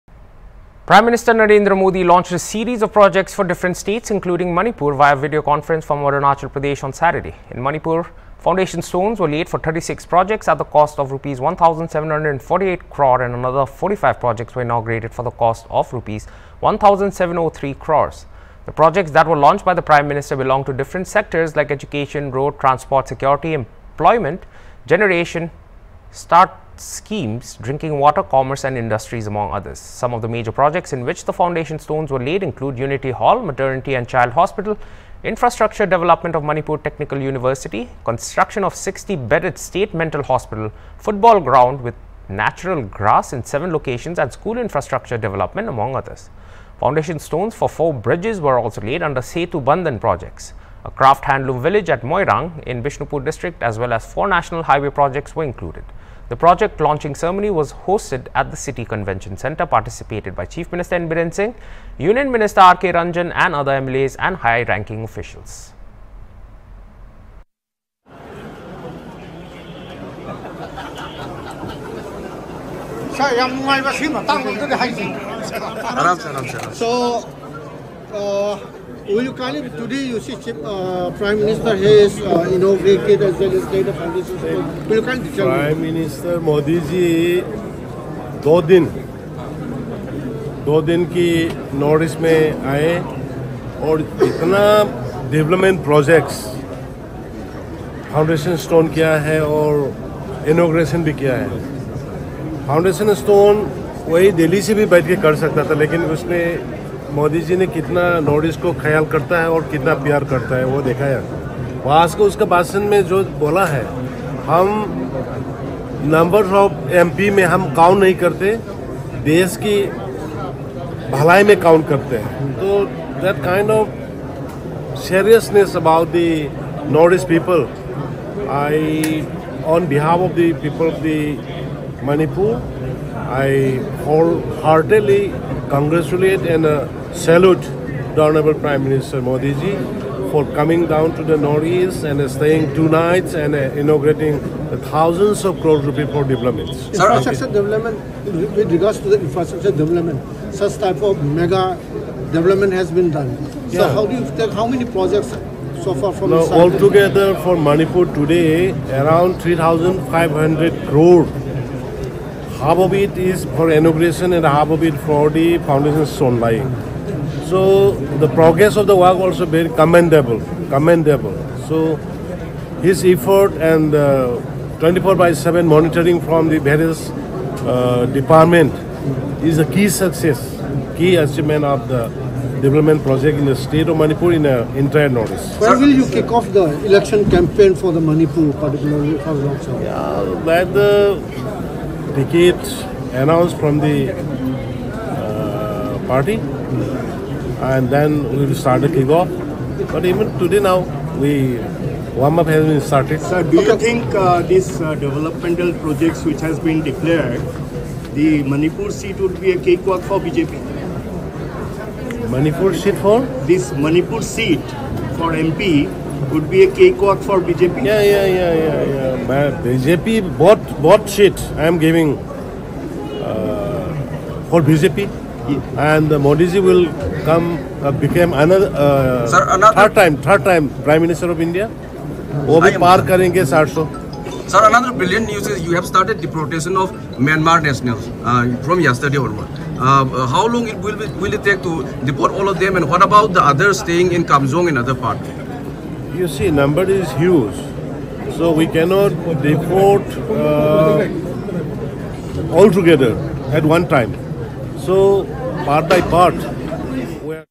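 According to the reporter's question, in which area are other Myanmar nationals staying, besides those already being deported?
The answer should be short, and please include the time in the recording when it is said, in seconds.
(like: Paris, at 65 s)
Kamzong, at 244 s.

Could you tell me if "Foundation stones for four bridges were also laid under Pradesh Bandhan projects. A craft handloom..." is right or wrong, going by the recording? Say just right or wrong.
wrong.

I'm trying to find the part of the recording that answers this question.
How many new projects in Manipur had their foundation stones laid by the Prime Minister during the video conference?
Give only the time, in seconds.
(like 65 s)
9 s.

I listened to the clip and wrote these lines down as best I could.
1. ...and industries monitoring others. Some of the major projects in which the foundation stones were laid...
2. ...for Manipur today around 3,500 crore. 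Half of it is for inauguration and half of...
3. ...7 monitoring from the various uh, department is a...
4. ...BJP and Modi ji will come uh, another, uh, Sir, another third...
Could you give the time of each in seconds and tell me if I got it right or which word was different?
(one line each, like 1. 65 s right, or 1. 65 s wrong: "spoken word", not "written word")
1. 28 s wrong: "among", not "monitoring"
2. 157 s right
3. 175 s right
4. 224 s right.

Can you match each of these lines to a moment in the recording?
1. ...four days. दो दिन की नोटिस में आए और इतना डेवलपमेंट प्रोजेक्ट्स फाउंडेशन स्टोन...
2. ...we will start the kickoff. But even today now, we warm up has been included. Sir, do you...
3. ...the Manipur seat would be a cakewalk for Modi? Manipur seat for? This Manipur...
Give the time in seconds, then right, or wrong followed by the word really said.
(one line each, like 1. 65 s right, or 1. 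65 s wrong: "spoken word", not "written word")
1. 88 s wrong: "two", not "four"
2. 198 s wrong: "started", not "included"
3. 208 s wrong: "BJP", not "Modi".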